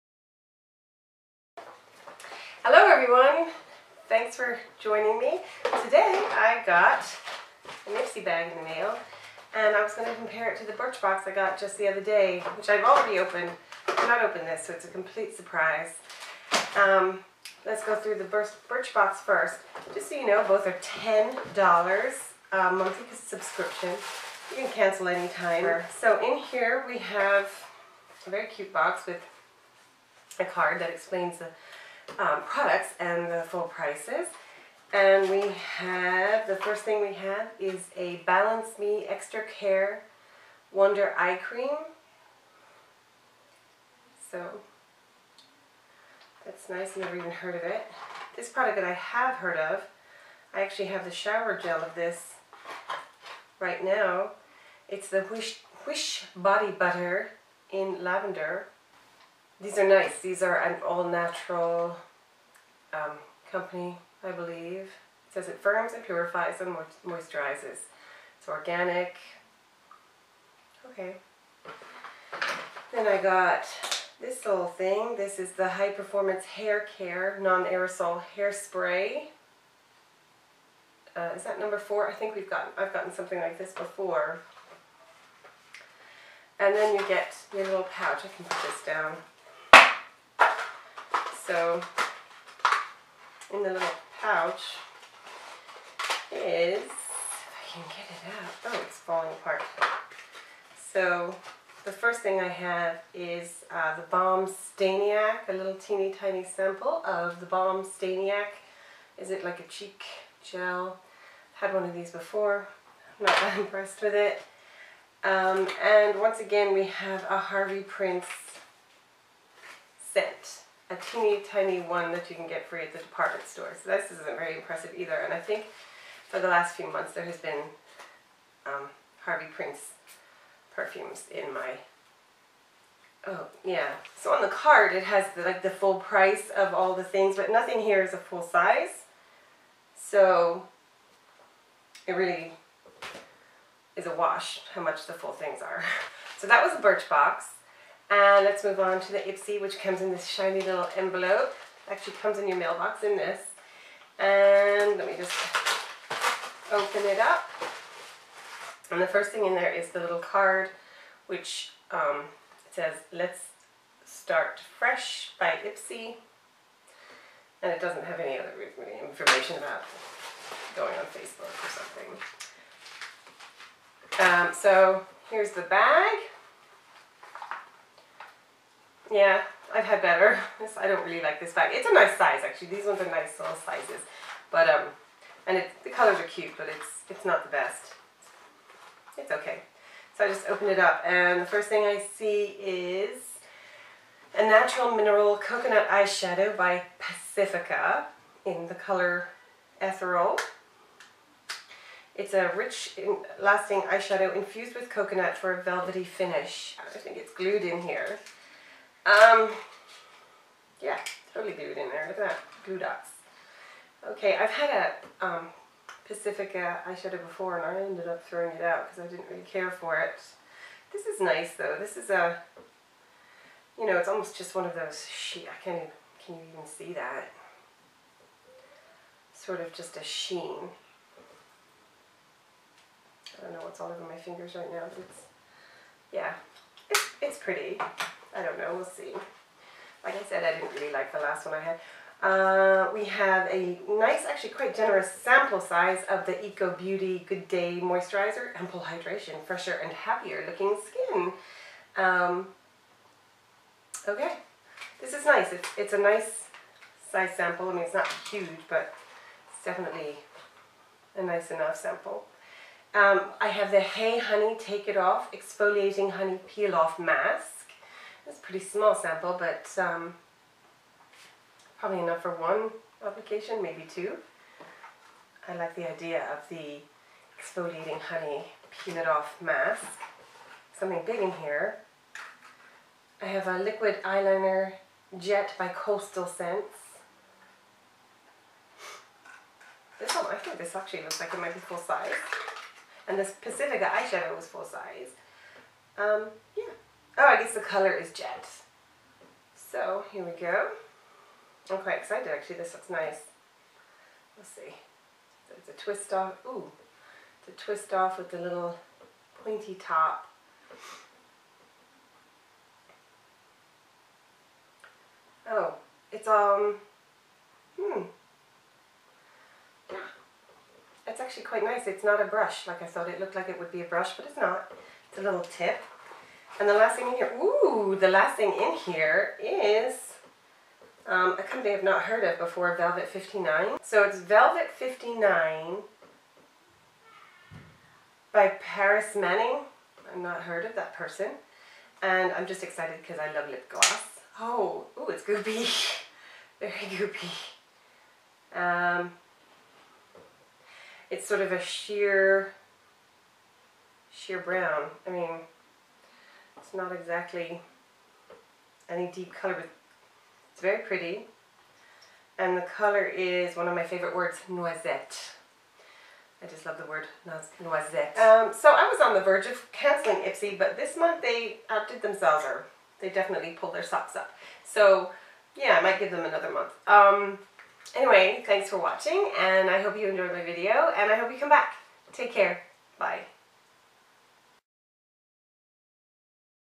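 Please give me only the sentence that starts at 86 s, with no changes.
And then you get your little pouch.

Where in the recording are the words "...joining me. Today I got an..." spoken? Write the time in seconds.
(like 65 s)
4 s.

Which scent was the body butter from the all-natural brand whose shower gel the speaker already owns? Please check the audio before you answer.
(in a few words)
Lavender.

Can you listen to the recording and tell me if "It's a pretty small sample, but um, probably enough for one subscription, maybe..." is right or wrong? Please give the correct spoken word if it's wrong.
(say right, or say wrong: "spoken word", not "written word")
wrong: "application", not "subscription".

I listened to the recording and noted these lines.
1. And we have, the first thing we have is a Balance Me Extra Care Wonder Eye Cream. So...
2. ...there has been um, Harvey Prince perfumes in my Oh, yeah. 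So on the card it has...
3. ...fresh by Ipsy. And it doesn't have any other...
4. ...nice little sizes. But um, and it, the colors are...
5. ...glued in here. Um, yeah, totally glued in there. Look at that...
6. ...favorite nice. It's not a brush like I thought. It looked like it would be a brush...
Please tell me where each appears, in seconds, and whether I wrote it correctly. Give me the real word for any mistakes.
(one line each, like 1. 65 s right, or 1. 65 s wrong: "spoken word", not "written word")
1. 34 s right
2. 127 s right
3. 164 s right
4. 183 s right
5. 207 s right
6. 321 s wrong: "quite", not "favorite".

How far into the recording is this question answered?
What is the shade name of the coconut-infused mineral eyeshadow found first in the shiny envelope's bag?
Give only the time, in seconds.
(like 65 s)
199 s.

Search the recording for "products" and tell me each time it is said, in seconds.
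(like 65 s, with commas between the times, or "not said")
32 s, 48 s.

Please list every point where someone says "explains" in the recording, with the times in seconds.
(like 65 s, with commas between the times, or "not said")
30 s.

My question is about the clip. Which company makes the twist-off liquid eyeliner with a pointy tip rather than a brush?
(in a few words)
Coastal Scents.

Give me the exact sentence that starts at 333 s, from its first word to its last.
So it's Velvet 59 by Paris Manning.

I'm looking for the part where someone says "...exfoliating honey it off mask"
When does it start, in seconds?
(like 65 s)
277 s.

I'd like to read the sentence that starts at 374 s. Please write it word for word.
So yeah, I might give them another month.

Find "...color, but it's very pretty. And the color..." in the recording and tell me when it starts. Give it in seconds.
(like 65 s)
359 s.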